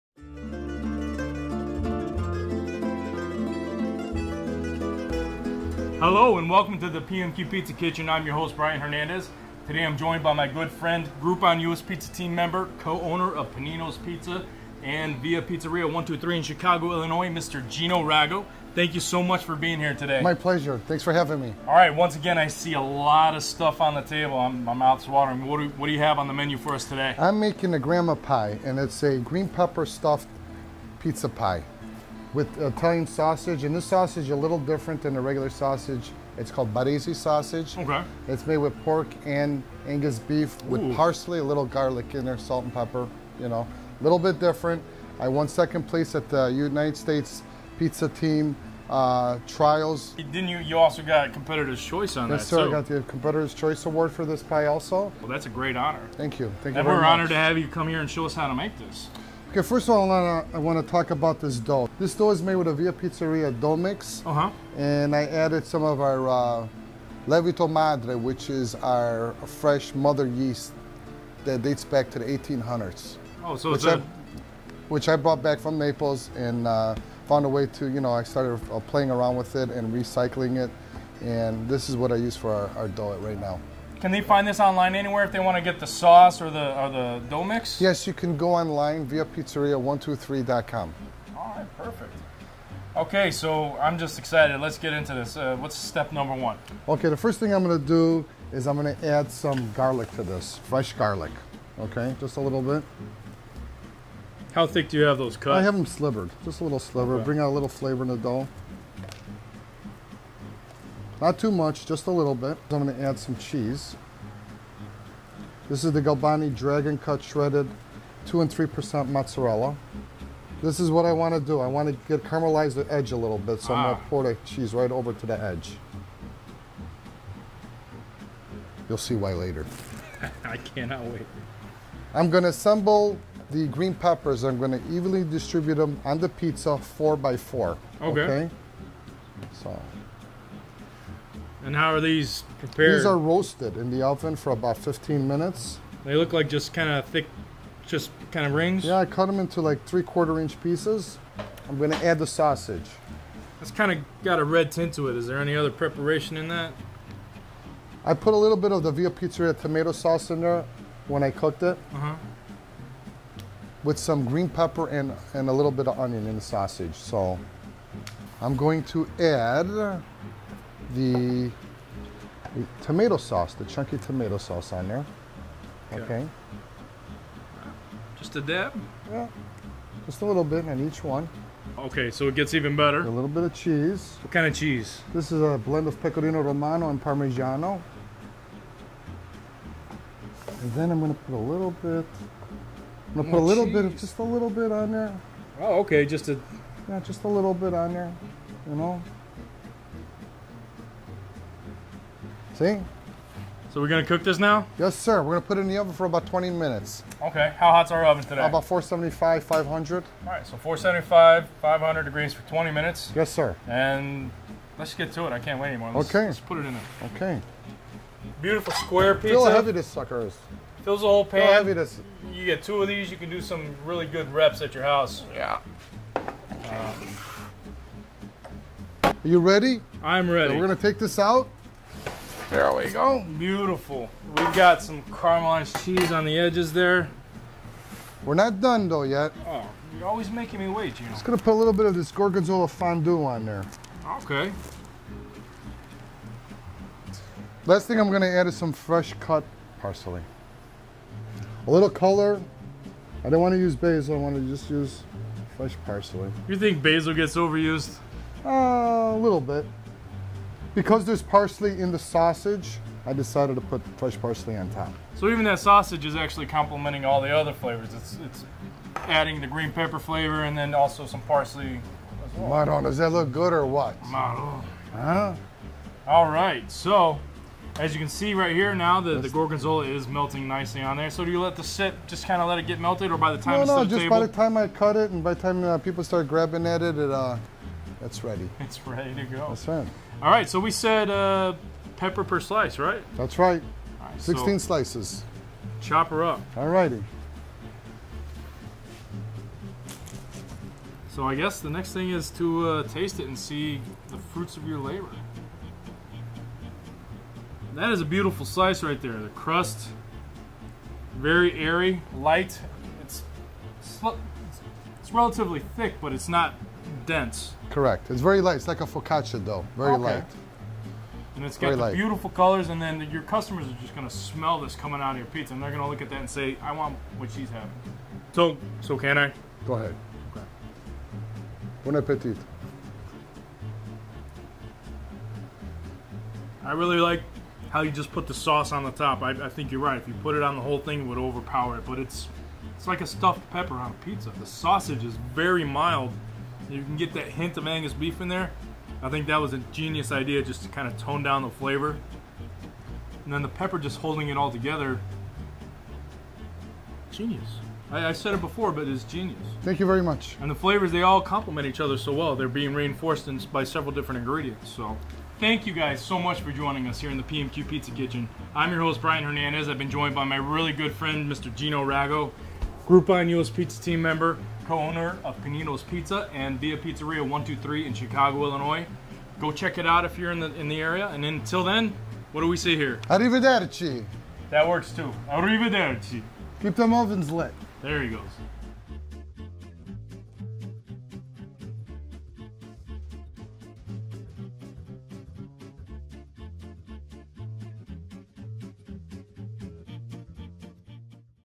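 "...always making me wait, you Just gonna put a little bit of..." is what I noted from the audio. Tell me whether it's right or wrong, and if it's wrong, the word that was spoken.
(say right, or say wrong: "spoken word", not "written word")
right.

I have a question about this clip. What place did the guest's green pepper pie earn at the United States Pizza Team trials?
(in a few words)
second place.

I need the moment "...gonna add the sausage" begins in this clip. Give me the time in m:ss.
2:31.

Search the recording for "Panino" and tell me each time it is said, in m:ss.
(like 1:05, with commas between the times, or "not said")
0:13, 6:15.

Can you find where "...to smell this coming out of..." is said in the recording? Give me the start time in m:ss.
5:24.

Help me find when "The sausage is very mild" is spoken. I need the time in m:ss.
5:44.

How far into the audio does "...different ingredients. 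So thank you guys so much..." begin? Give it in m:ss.
6:03.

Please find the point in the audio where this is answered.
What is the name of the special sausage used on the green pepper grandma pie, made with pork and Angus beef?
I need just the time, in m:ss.
0:36.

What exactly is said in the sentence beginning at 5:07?
That is a beautiful slice right there.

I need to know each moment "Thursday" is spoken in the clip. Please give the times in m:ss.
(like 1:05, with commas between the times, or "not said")
not said.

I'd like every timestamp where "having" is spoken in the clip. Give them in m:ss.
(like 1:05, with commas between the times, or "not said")
0:21, 5:27.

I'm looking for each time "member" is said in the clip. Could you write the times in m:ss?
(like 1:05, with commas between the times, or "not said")
0:12, 6:14.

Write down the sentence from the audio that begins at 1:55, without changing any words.
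This is the Galbani Dragon Cut Shredded 2 and 3% mozzarella.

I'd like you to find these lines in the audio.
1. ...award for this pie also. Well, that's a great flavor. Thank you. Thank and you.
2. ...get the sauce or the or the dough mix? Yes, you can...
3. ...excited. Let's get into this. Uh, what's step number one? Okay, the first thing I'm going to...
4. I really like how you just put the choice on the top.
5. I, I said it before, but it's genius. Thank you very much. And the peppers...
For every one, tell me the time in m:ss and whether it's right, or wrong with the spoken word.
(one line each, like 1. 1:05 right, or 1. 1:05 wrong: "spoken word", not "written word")
1. 0:53 wrong: "honor", not "flavor"
2. 1:25 right
3. 1:34 right
4. 5:36 wrong: "sauce", not "choice"
5. 5:57 wrong: "flavors", not "peppers".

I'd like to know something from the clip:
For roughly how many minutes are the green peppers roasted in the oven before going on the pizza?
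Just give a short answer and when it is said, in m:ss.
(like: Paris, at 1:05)
15 minutes, at 2:24.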